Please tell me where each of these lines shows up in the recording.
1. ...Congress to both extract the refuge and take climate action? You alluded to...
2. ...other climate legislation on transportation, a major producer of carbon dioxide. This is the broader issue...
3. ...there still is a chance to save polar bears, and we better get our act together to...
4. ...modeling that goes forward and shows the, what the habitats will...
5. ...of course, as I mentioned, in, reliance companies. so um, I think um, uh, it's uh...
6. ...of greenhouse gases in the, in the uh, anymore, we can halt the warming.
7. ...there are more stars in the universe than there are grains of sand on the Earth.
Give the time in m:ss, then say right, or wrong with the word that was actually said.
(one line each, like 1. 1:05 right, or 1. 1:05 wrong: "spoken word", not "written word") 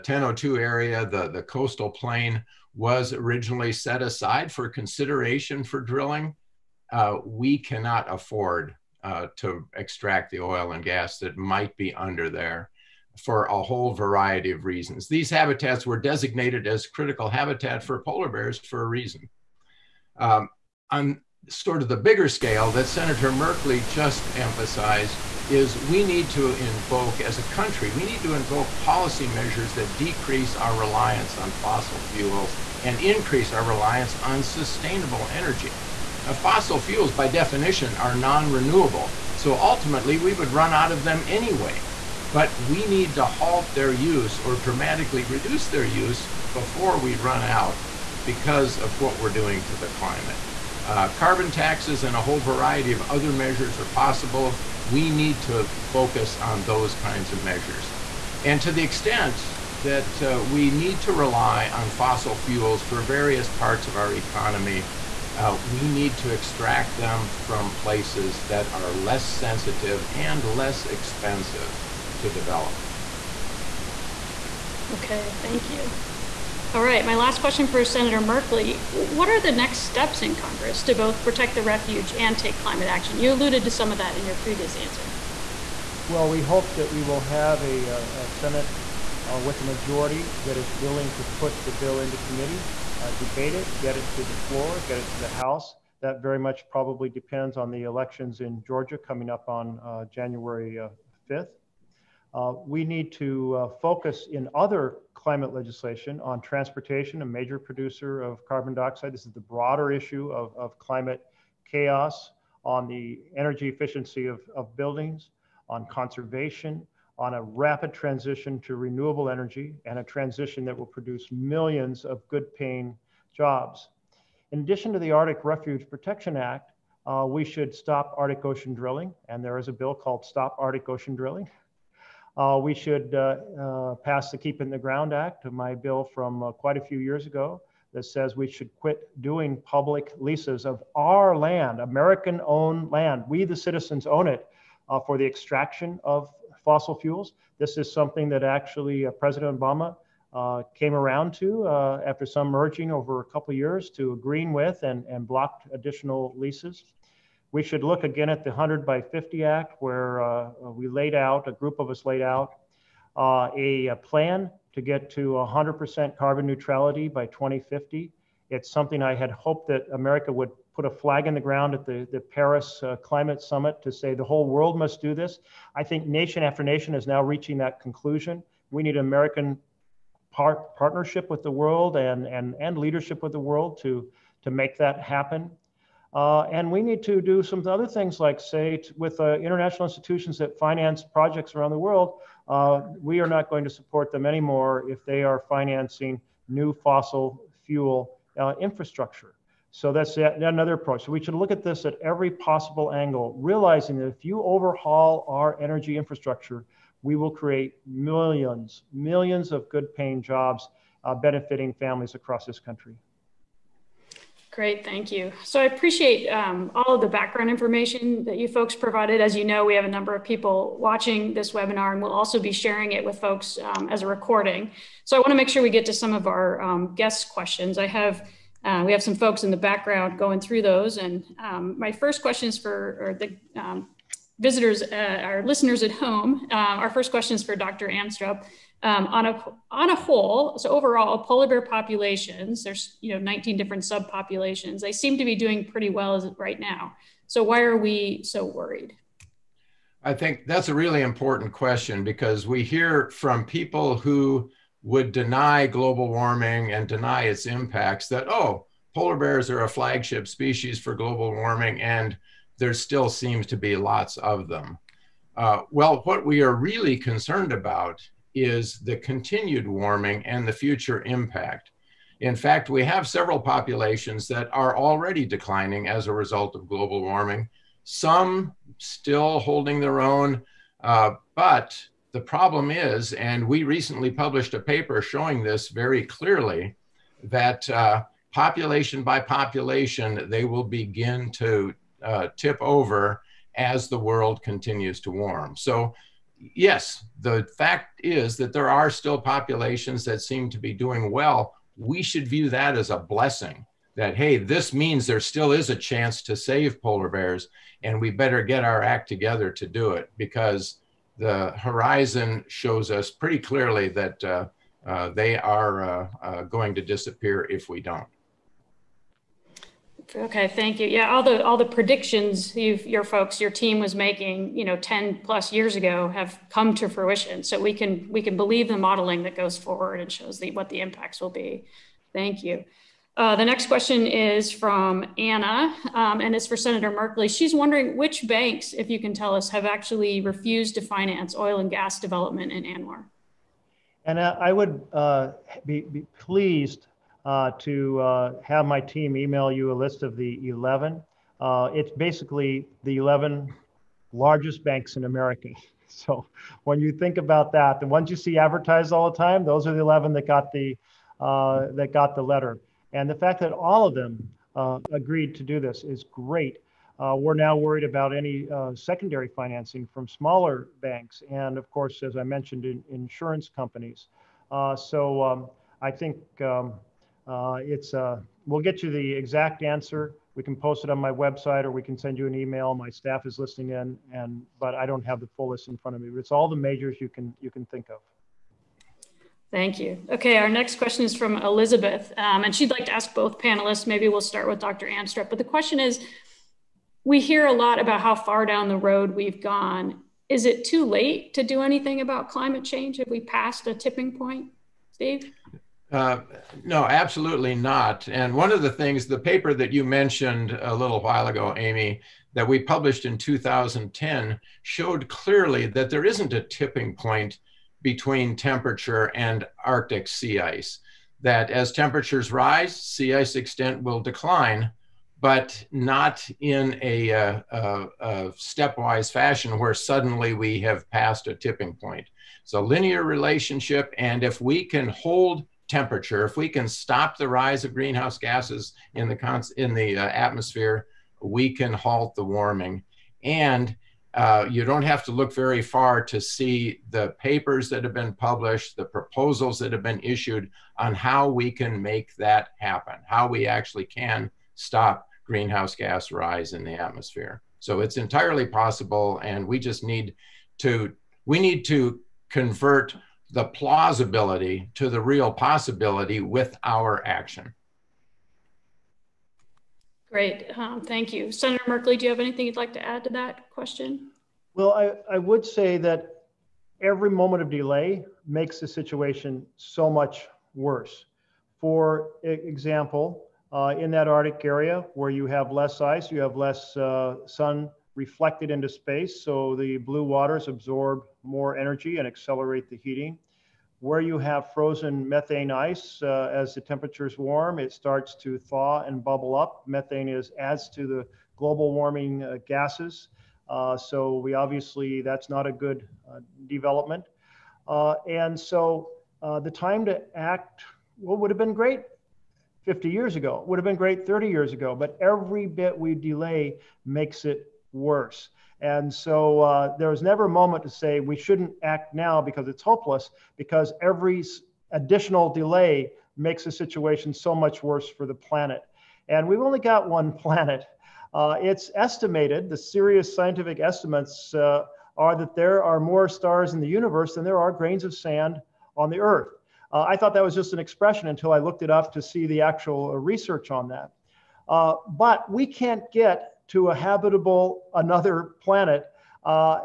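1. 1:20 wrong: "protect", not "extract"
2. 1:44 right
3. 5:05 right
4. 5:28 wrong: "impacts", not "habitats"
5. 6:11 wrong: "insurance", not "reliance"
6. 7:17 wrong: "atmosphere", not "anymore"
7. 8:55 right.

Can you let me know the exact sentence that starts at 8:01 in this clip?
For example, uh, in that Arctic area where you have less ice, you have less uh, sun reflected into space.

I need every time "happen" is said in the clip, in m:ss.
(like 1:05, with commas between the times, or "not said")
3:04, 7:32.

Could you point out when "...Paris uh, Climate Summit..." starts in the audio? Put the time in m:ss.
2:52.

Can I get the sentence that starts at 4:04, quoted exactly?
They seem to be doing pretty well right now.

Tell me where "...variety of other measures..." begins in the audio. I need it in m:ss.
0:52.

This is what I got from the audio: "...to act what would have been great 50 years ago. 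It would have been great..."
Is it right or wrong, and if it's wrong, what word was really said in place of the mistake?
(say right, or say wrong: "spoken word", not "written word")
right.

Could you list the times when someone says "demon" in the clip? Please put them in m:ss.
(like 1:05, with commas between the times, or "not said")
not said.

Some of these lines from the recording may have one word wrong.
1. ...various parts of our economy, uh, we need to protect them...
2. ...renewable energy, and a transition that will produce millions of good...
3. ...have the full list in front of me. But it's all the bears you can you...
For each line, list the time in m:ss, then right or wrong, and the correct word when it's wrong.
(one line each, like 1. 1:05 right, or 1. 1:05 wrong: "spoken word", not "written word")
1. 1:03 wrong: "extract", not "protect"
2. 1:58 right
3. 6:25 wrong: "majors", not "bears".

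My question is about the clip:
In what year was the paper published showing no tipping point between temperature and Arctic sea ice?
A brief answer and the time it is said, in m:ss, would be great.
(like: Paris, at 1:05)
2010, at 6:53.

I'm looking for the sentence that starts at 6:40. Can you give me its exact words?
Is it too late to do anything about climate change?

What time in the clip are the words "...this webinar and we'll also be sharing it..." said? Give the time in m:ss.
3:41.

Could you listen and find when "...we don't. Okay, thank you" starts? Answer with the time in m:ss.
5:17.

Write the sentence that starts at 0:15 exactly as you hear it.
These habitats were designated as critical habitat for polar bears for a reason.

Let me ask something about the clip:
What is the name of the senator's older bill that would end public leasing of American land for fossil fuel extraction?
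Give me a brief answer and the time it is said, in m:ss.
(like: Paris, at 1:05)
Keep in the Ground Act, at 2:14.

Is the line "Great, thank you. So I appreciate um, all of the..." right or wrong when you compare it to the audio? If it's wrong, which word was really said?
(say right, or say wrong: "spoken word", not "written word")
right.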